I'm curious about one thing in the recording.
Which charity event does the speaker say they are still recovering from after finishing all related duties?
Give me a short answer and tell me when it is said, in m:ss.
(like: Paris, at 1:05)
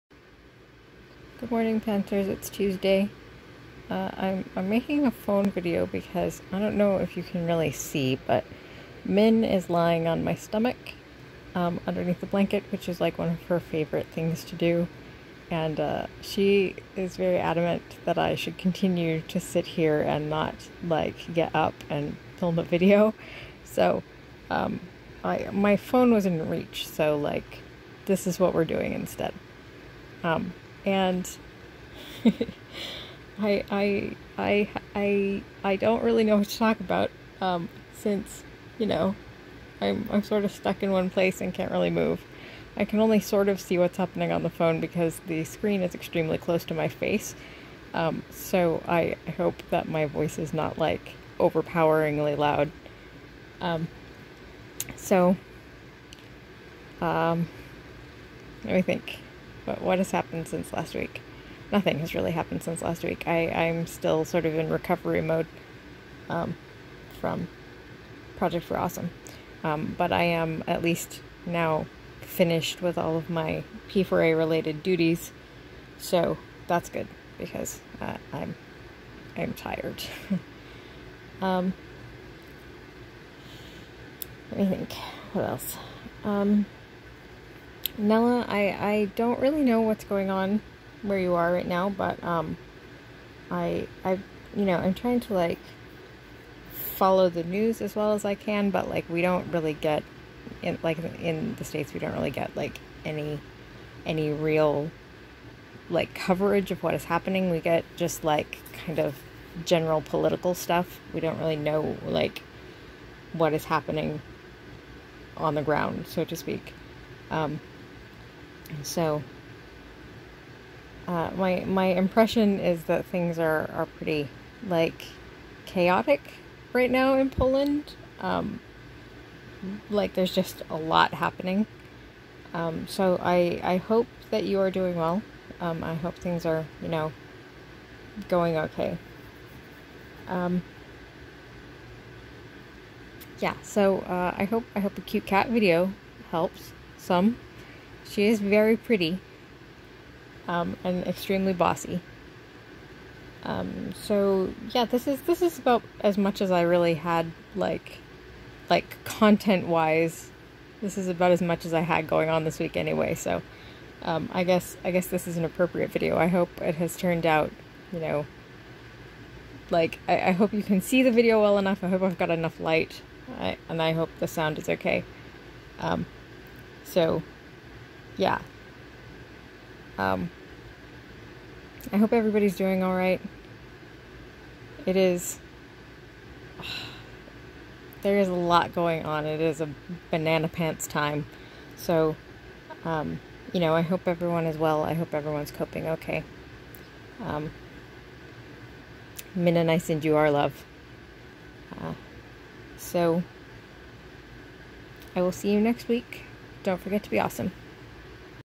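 Project for Awesome, at 1:08.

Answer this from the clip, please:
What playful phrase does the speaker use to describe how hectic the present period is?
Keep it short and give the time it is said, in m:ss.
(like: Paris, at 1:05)
banana pants, at 3:10.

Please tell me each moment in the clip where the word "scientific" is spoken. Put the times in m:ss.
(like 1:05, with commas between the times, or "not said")
not said.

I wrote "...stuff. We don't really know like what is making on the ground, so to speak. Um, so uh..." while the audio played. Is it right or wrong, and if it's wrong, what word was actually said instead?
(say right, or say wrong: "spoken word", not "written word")
wrong: "happening", not "making".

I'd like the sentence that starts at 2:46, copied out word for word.
I hope it has turned out, you know.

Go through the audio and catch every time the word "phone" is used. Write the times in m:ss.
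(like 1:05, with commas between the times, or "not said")
0:05, 0:25, 0:44.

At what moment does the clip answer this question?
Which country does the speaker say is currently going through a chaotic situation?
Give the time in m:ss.
2:07.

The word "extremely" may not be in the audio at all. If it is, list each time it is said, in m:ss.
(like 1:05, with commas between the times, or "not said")
0:45, 2:31.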